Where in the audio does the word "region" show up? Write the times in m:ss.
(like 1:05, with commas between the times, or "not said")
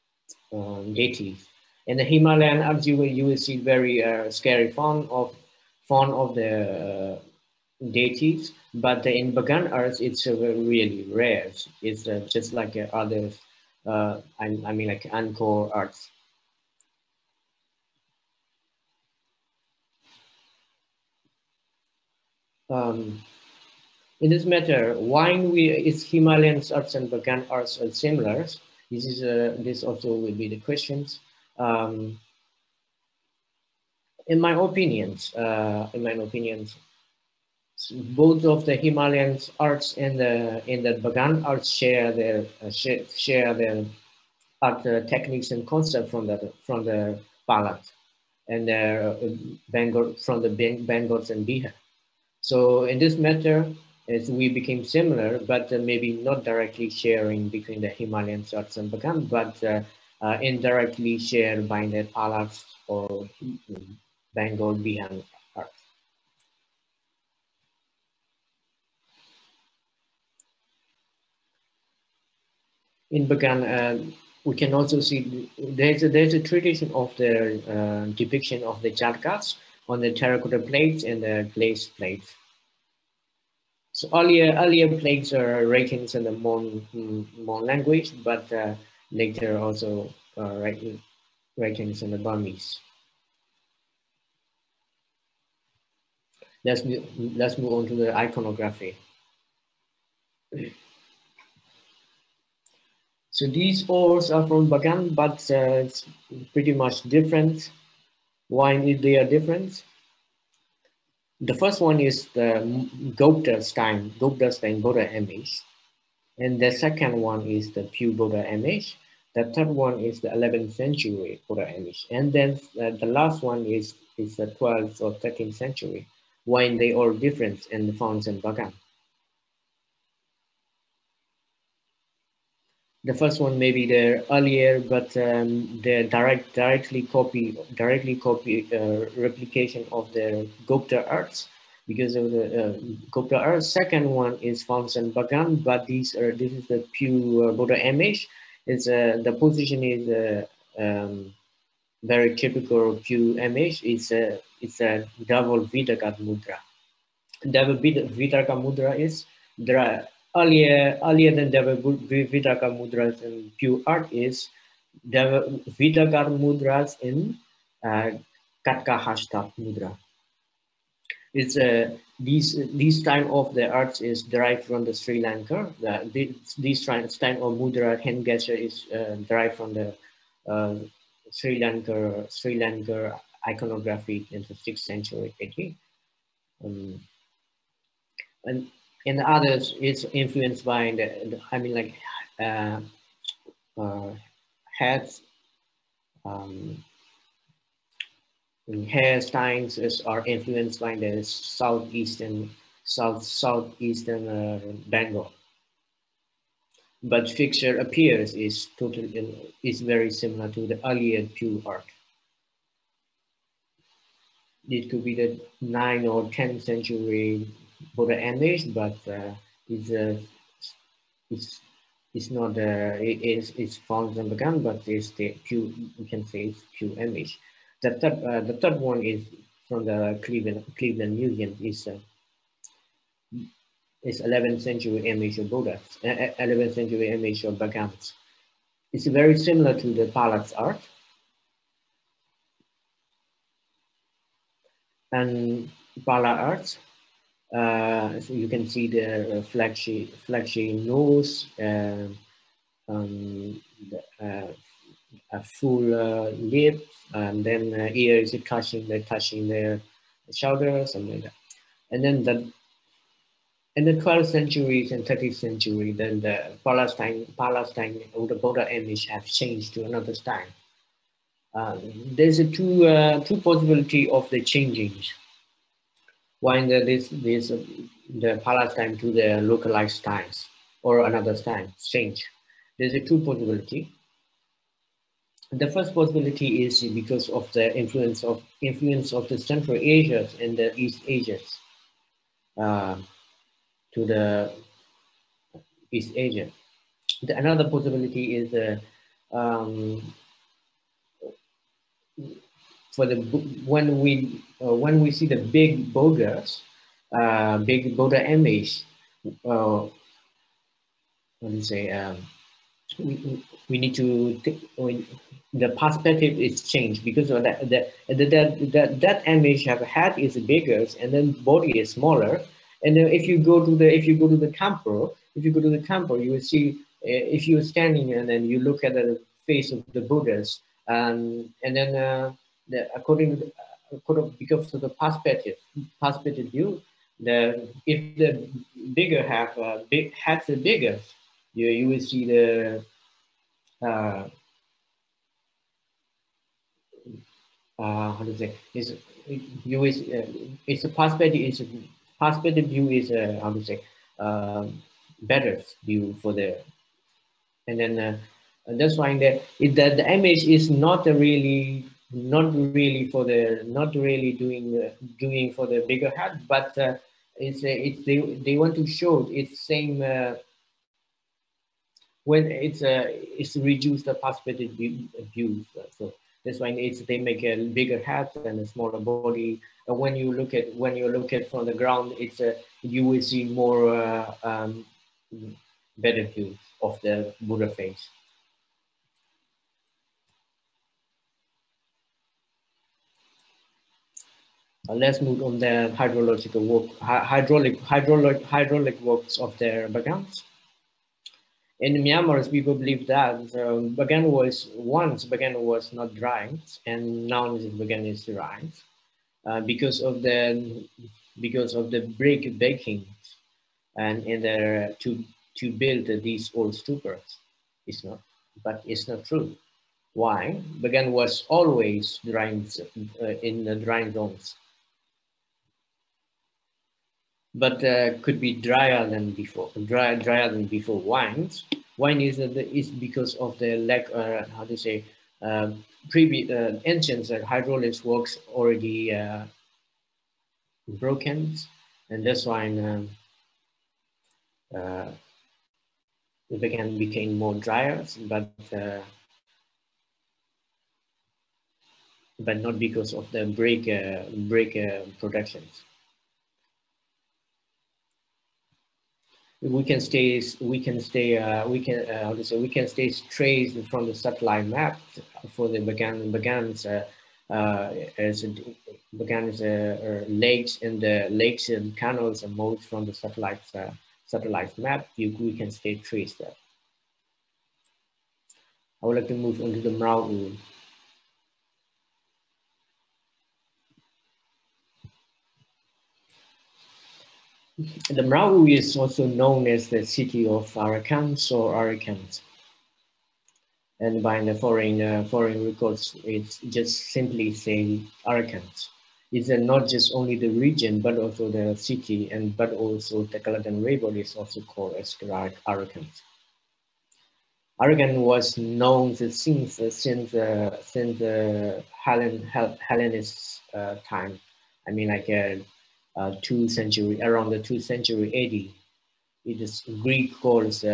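8:20.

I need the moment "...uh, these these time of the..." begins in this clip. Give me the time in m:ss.
2:51.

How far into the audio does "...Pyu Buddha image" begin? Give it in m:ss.
1:57.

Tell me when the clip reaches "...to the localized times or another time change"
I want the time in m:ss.
4:38.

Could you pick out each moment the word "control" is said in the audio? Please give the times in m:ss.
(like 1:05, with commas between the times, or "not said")
not said.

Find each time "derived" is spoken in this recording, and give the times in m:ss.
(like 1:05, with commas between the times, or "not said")
2:54, 2:59.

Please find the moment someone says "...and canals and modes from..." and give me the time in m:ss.
7:51.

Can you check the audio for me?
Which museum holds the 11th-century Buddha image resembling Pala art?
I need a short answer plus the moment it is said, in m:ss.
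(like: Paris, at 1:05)
Cleveland Museum, at 3:50.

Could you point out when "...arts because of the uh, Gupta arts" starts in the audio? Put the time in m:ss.
2:21.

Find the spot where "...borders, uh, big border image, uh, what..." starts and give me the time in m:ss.
5:05.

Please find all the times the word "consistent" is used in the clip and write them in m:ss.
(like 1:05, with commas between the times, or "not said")
not said.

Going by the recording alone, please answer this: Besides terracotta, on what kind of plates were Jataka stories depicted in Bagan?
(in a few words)
Glaze plates.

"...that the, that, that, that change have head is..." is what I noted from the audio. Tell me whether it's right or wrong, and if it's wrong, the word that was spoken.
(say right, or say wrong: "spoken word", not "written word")
wrong: "image", not "change".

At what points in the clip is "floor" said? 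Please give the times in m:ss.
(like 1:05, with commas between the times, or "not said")
not said.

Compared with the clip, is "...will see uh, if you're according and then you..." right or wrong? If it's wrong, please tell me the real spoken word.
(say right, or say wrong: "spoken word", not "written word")
wrong: "standing", not "according".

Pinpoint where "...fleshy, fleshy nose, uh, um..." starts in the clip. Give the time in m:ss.
4:09.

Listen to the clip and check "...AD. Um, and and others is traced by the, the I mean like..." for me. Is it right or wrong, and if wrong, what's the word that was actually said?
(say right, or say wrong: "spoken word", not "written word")
wrong: "influenced", not "traced".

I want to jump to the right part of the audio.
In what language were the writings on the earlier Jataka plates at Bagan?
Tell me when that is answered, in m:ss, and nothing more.
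1:26.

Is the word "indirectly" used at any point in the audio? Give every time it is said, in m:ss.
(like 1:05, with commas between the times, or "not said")
1:00.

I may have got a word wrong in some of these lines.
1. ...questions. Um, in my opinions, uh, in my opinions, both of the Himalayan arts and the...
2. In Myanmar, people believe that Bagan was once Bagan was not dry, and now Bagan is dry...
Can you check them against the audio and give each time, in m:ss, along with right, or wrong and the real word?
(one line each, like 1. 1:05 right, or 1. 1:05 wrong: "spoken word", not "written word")
1. 0:30 right
2. 6:41 right.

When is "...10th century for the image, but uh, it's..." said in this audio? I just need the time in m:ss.
3:36.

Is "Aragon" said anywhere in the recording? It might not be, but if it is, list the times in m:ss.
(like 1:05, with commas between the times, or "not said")
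8:27.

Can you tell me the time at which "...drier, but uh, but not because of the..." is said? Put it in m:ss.
7:27.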